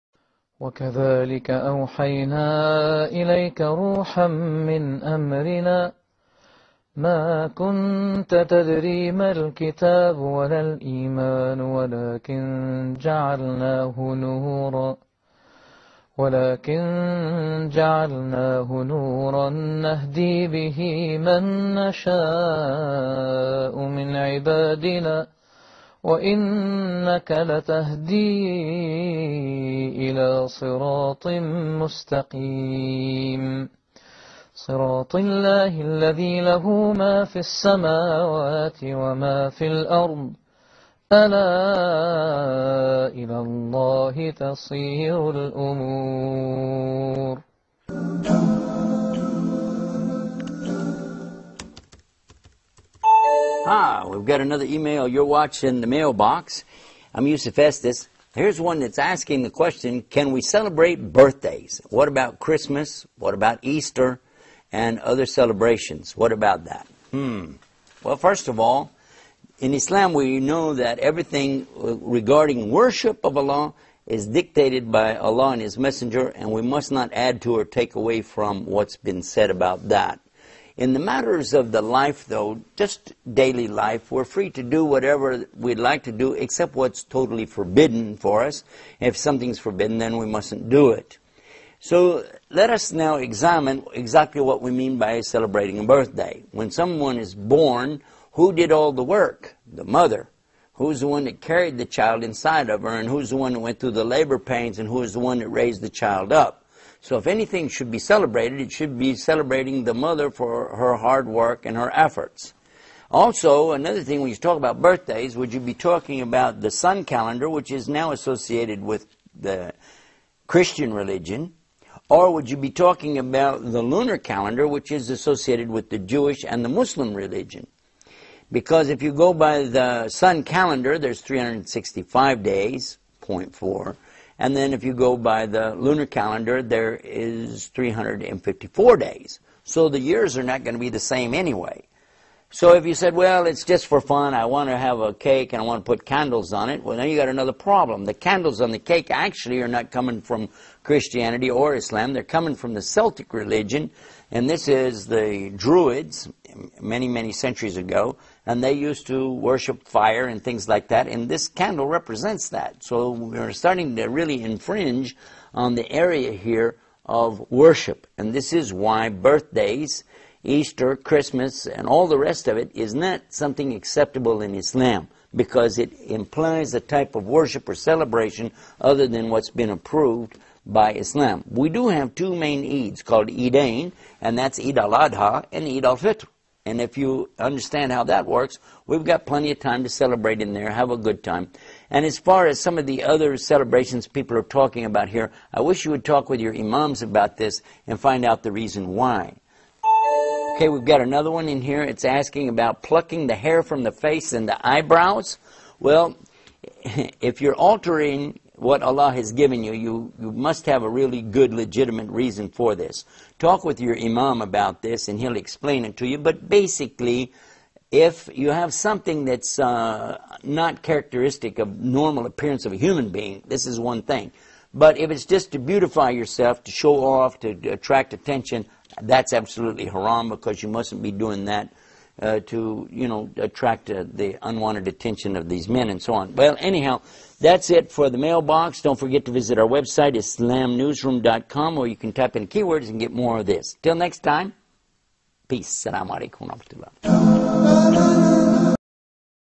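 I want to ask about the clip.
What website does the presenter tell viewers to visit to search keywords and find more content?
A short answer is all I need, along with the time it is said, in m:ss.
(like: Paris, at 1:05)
islamnewsroom.com, at 4:00.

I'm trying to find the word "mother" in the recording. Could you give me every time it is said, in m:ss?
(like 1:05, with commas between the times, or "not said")
1:39, 1:49.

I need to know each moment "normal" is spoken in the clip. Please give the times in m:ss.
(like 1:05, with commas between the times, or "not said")
3:41.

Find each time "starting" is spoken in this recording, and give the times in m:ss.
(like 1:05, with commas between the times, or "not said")
2:43.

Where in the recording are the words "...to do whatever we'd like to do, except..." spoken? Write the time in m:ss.
1:24.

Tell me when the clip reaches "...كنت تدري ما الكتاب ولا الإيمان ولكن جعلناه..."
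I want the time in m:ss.
0:07.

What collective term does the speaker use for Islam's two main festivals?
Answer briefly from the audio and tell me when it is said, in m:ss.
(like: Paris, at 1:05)
Eidain, at 3:03.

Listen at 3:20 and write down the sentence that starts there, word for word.
Okay, we've got another one in here.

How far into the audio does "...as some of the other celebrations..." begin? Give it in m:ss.
3:12.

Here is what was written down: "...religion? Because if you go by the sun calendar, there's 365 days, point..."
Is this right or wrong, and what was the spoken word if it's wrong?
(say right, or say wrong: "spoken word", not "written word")
right.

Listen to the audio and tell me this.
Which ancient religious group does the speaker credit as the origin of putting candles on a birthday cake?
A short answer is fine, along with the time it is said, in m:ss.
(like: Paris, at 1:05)
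The Druids, at 2:35.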